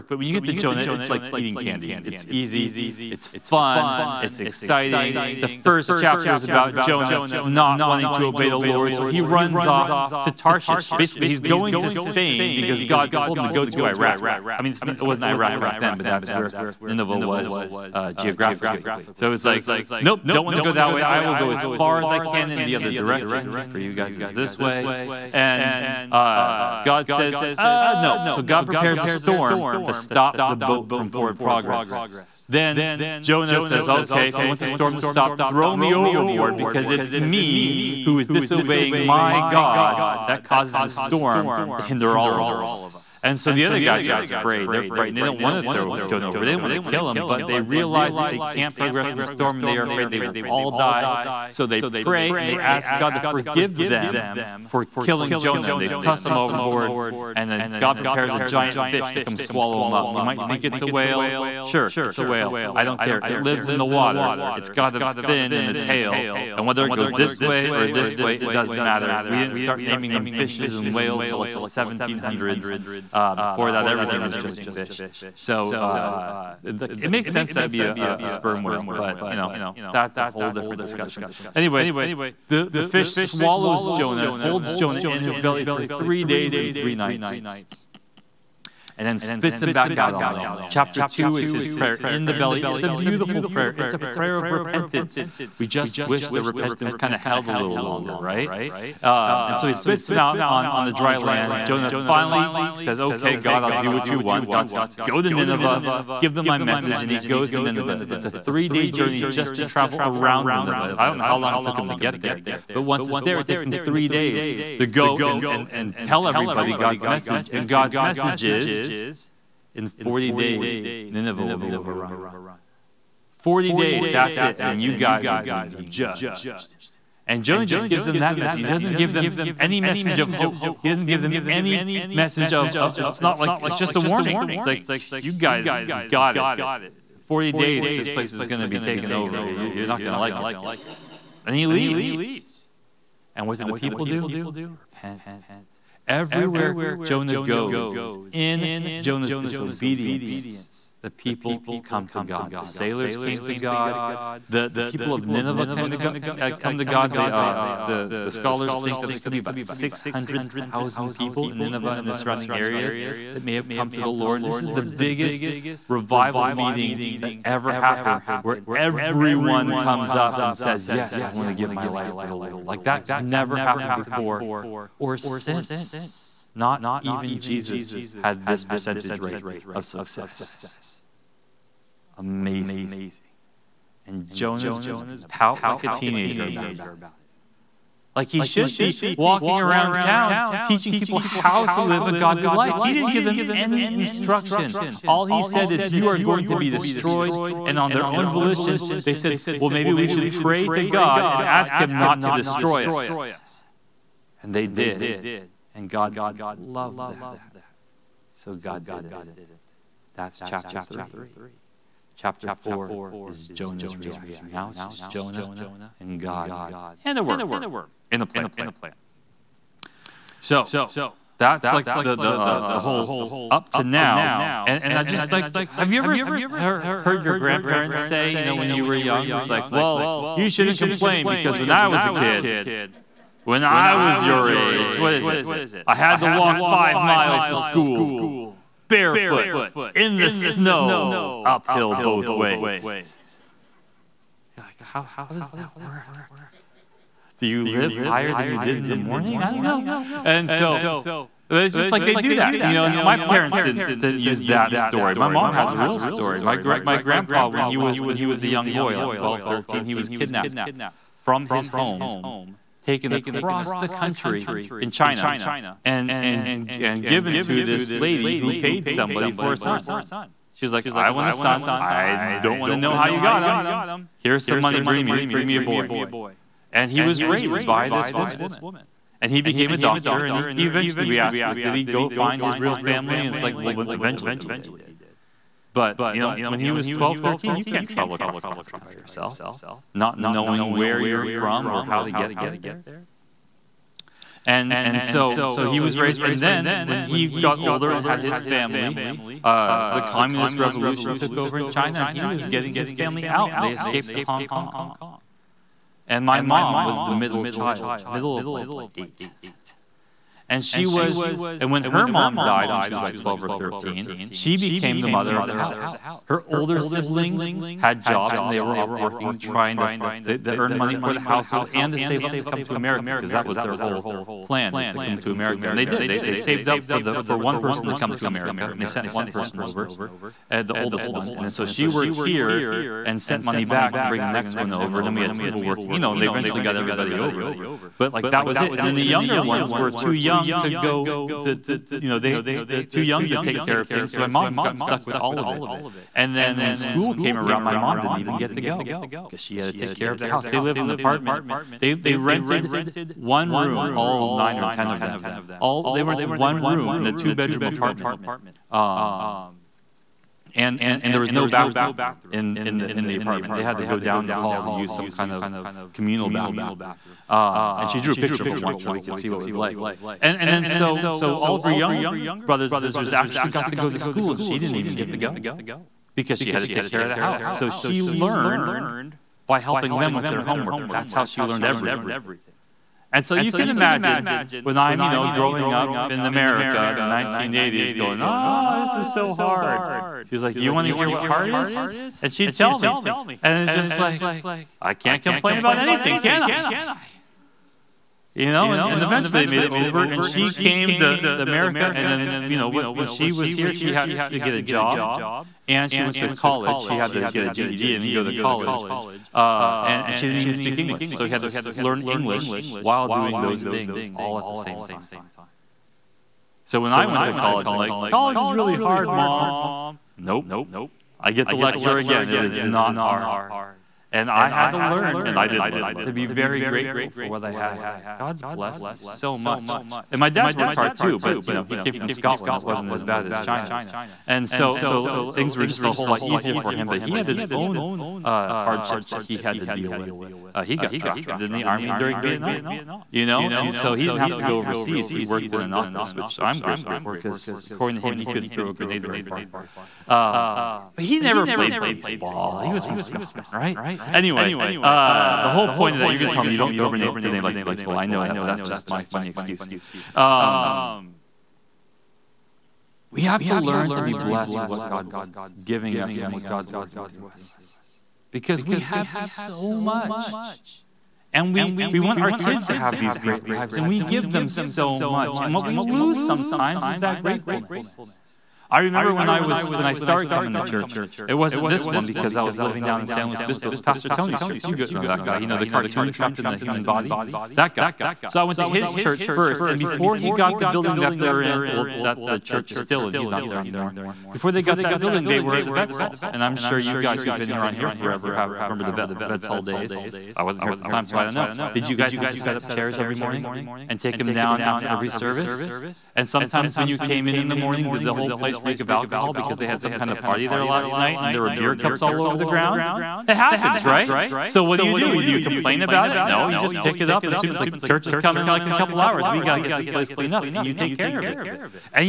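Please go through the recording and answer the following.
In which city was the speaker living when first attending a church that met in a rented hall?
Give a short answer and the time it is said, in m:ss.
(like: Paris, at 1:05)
San Luis Obispo, at 8:03.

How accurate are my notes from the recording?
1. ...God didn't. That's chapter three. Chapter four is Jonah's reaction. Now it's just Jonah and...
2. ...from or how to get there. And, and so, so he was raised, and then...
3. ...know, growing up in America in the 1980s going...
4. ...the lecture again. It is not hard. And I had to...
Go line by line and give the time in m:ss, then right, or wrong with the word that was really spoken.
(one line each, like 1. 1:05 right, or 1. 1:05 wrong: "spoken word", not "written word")
1. 3:28 right
2. 4:51 right
3. 6:25 right
4. 7:01 right.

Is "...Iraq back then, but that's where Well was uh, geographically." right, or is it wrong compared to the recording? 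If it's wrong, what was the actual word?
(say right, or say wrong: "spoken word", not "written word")
wrong: "Nineveh", not "Well".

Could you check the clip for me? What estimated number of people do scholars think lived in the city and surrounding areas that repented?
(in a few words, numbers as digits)
600,000.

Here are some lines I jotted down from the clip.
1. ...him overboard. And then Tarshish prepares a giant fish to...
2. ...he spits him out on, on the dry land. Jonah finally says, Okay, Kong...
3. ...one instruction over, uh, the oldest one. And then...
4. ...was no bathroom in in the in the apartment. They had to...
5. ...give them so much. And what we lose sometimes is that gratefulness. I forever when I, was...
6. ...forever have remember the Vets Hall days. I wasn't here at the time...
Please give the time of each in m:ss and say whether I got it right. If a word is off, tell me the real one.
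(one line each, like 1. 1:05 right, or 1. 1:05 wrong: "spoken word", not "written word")
1. 0:56 wrong: "God", not "Tarshish"
2. 1:39 wrong: "God", not "Kong"
3. 5:29 wrong: "person", not "instruction"
4. 6:01 right
5. 7:54 wrong: "remember", not "forever"
6. 8:17 right.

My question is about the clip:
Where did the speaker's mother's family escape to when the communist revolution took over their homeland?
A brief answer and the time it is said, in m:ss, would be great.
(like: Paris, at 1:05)
Hong Kong, at 5:04.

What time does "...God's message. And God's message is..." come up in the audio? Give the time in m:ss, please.
1:56.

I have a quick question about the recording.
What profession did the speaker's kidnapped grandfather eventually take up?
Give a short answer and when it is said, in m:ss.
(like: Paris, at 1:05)
doctor, at 4:39.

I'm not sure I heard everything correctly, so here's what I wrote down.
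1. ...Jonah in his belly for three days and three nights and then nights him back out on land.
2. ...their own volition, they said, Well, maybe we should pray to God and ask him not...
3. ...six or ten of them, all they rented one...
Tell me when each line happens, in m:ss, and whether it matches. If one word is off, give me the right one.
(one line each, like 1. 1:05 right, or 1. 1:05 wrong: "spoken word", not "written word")
1. 1:24 wrong: "spits", not "nights"
2. 3:17 right
3. 5:54 wrong: "nine", not "six".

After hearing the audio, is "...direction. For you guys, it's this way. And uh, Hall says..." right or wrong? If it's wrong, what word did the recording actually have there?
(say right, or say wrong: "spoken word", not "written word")
wrong: "God", not "Hall".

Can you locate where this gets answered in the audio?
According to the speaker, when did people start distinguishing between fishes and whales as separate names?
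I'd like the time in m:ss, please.
1:11.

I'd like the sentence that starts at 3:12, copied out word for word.
He didn't give them any instruction.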